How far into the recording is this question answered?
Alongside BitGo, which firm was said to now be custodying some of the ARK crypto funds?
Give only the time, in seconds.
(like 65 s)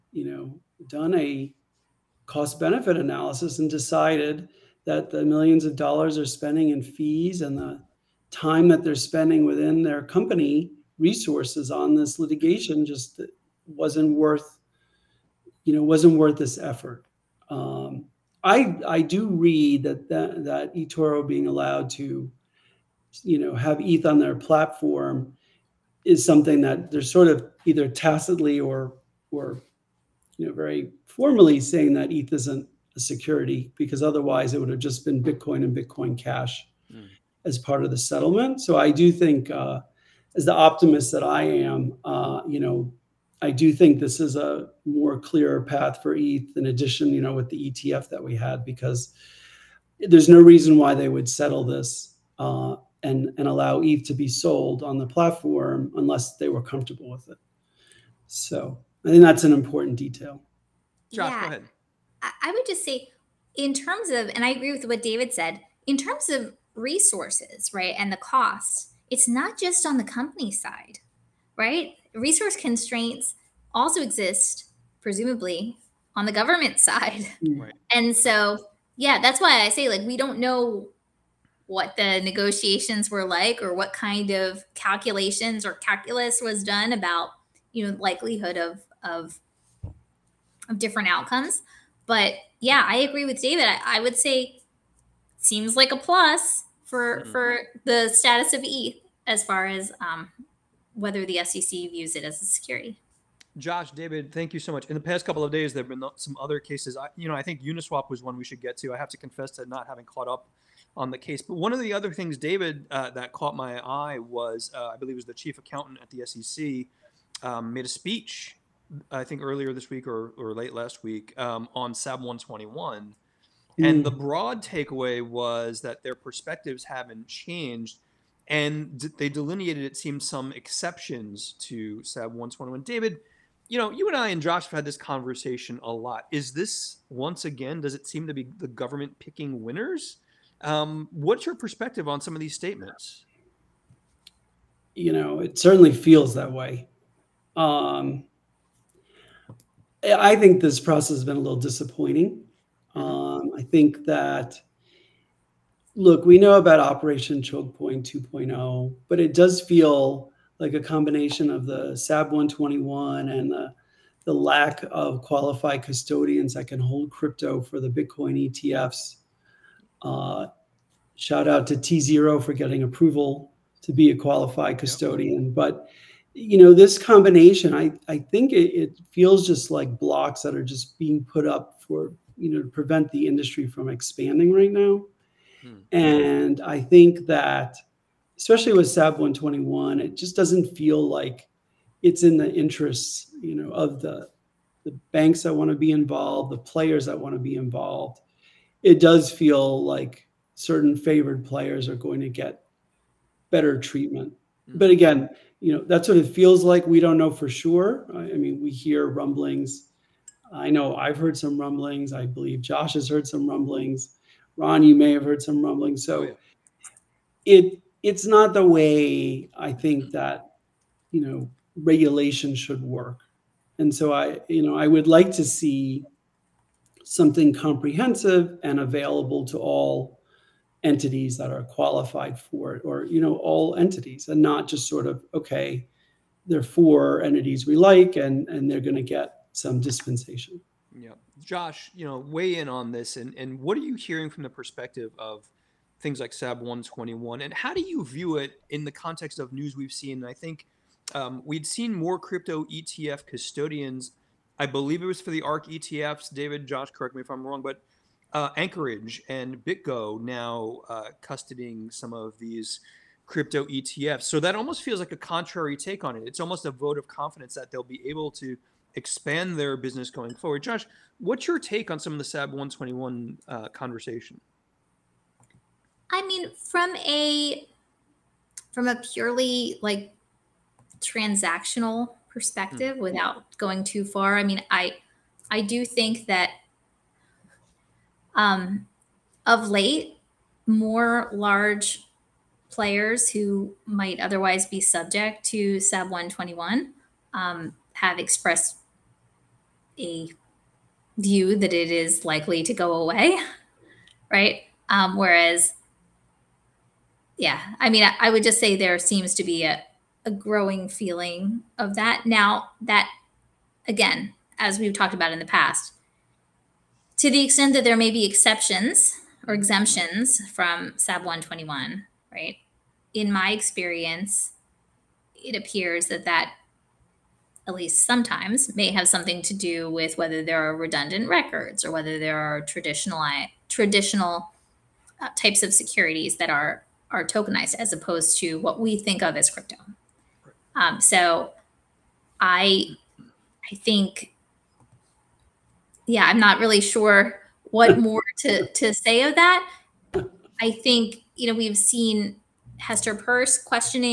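258 s.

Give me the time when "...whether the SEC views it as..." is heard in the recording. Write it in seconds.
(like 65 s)
100 s.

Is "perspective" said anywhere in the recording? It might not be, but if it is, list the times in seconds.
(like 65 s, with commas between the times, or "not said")
126 s, 141 s, 244 s, 282 s.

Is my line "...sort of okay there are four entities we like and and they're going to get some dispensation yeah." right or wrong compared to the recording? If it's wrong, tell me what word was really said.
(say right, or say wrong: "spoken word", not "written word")
right.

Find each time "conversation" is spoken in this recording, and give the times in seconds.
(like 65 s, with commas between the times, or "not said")
134 s, 273 s.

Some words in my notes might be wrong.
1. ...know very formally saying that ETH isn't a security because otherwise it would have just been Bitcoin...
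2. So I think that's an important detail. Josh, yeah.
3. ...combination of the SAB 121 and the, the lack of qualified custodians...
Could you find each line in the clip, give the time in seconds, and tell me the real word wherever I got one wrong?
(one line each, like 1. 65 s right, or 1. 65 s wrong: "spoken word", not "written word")
1. 30 s right
2. 58 s right
3. 160 s right.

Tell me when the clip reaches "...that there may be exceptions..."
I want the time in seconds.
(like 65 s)
317 s.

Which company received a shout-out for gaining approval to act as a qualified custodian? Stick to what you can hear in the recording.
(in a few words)
tZERO.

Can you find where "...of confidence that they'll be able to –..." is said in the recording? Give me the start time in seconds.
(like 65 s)
266 s.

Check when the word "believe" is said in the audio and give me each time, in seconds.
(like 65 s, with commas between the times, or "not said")
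114 s, 212 s, 254 s.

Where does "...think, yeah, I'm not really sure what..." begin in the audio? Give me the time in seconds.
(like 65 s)
343 s.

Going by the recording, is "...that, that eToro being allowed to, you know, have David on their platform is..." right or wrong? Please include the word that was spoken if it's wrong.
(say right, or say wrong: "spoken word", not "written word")
wrong: "ETH", not "David".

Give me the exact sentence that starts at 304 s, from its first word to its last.
Um, whereas, yeah, I mean, I, I would just say there seems to be a, a growing feeling of that.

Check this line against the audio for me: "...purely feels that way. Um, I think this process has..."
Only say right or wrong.
wrong.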